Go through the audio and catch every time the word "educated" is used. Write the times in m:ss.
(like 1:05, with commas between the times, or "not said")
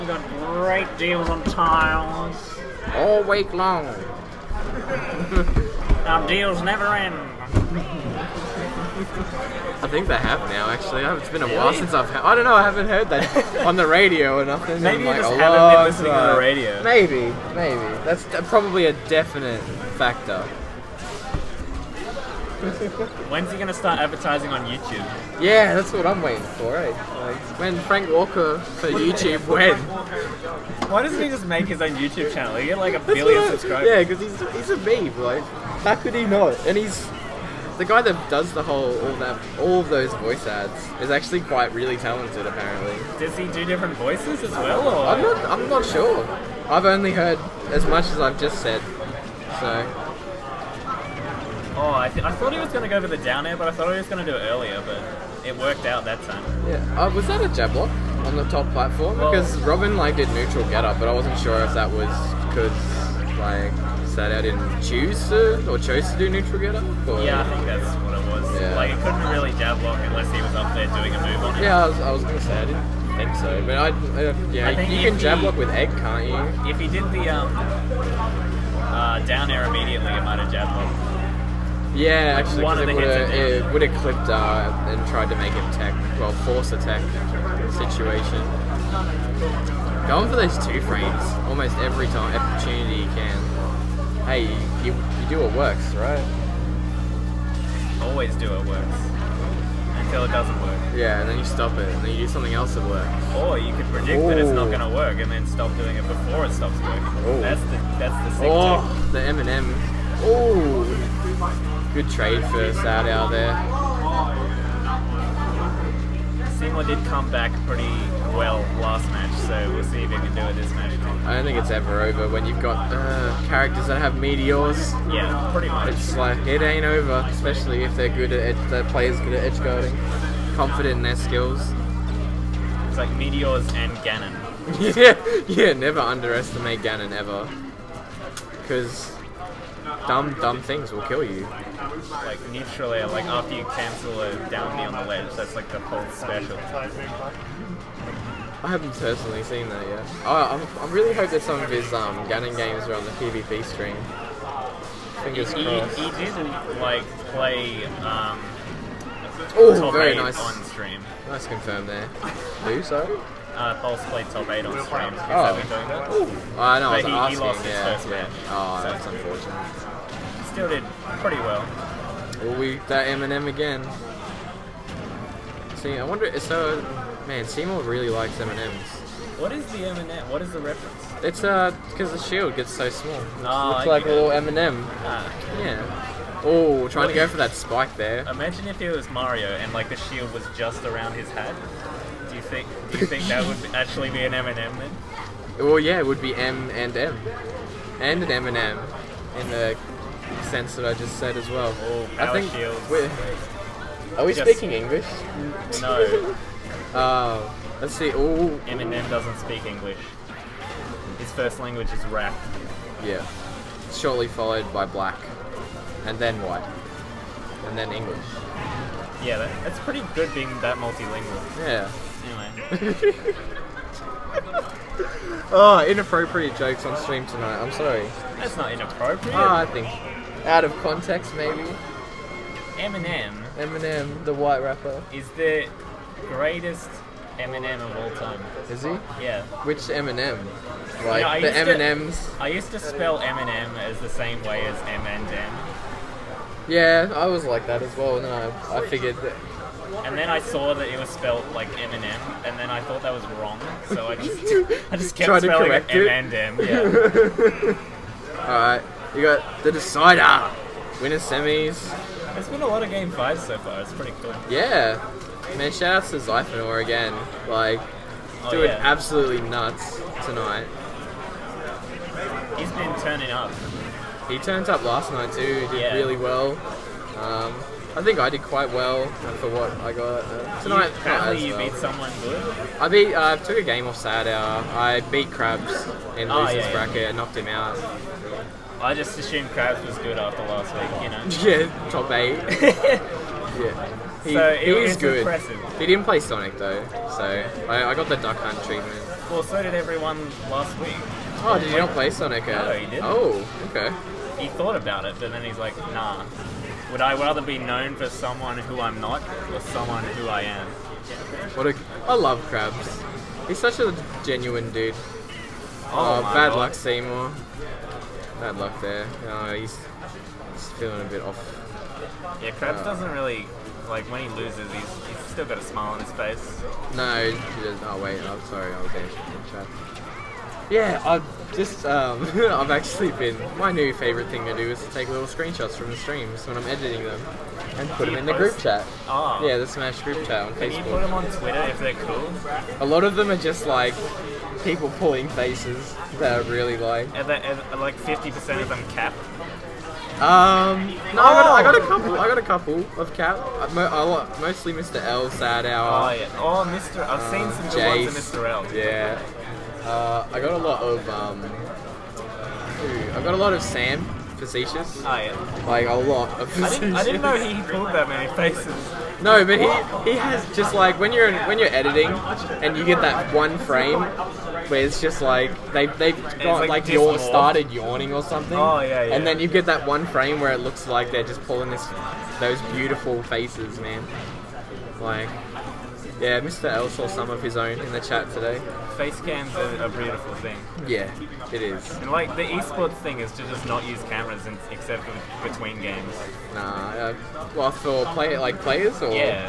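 not said.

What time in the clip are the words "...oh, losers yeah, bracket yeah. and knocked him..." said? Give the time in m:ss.
4:46.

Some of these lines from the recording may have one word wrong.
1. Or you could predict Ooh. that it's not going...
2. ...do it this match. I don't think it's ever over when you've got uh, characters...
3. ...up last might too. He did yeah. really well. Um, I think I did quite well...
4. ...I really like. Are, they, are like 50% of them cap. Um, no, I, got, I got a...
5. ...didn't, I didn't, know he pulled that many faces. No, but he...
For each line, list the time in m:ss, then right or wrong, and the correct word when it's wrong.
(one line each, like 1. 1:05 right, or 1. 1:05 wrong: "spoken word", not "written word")
1. 1:43 right
2. 2:00 right
3. 4:34 wrong: "night", not "might"
4. 5:46 right
5. 6:06 right.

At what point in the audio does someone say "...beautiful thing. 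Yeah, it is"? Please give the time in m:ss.
6:29.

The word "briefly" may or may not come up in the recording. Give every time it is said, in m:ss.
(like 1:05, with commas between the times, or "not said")
not said.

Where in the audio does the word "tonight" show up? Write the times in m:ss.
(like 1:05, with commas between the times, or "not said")
3:47, 4:30, 4:40.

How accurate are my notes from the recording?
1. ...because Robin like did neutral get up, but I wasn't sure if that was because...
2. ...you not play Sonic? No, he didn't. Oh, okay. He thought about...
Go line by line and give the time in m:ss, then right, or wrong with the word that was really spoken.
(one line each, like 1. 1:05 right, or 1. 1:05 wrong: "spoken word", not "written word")
1. 0:59 right
2. 5:01 right.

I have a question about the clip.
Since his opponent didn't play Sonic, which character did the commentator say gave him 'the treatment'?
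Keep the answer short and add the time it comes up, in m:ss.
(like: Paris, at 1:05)
Duck Hunt, at 4:58.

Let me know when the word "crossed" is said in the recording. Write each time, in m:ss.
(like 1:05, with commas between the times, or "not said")
2:35.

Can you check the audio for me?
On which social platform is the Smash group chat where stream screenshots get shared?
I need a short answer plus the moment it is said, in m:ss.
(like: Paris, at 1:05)
Facebook, at 5:40.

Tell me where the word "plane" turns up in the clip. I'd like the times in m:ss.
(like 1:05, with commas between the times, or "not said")
not said.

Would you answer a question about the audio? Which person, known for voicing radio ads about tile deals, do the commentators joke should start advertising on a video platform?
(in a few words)
Frank Walker.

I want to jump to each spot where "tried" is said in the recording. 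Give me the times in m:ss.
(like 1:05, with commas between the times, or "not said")
1:25, 4:15.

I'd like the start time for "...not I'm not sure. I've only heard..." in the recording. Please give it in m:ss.
0:45.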